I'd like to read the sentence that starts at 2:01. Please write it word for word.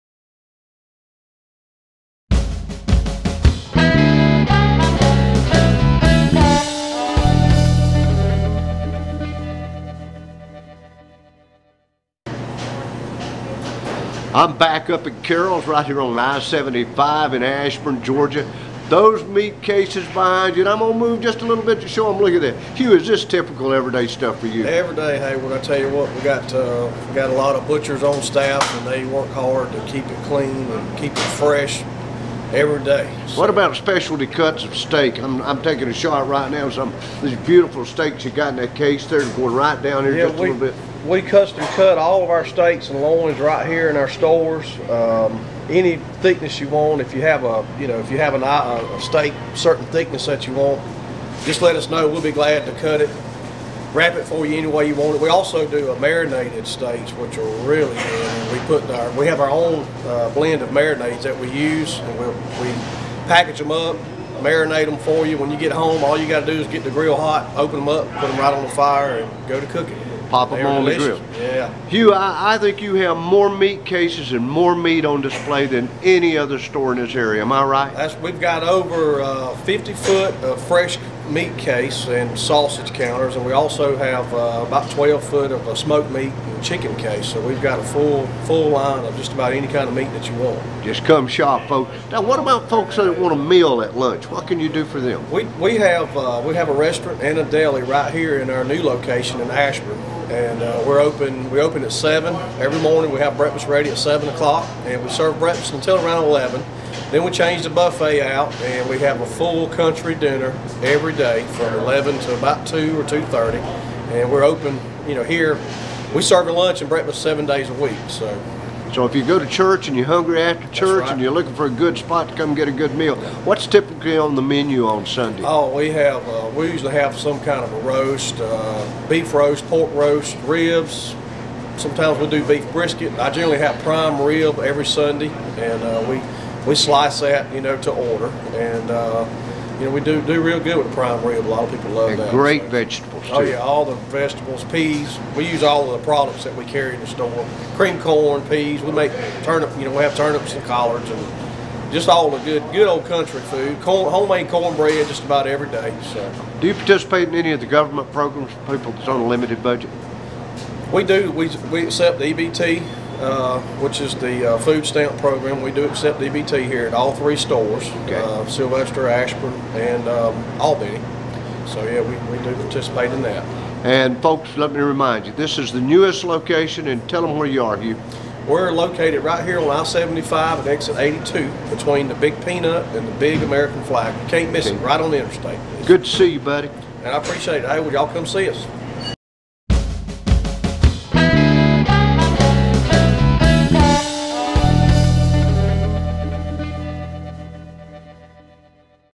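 and you're looking for a good spot to come get a good meal, what's typically on the menu on Sunday?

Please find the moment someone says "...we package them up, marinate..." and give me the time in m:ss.
1:02.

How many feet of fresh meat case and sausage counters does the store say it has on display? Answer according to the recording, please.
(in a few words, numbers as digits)
50 feet.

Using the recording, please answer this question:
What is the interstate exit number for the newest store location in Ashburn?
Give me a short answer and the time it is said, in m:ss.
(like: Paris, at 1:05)
82, at 3:00.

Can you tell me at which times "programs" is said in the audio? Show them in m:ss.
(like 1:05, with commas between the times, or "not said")
2:38, 2:45.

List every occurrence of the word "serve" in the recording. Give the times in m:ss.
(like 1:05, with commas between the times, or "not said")
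1:45, 1:56.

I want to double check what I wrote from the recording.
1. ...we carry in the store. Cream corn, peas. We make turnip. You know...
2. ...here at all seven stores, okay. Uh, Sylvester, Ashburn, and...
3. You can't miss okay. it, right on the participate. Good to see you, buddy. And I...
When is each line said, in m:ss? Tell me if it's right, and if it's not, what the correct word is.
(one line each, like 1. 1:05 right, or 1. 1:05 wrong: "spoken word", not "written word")
1. 2:26 right
2. 2:46 wrong: "three", not "seven"
3. 3:04 wrong: "interstate", not "participate".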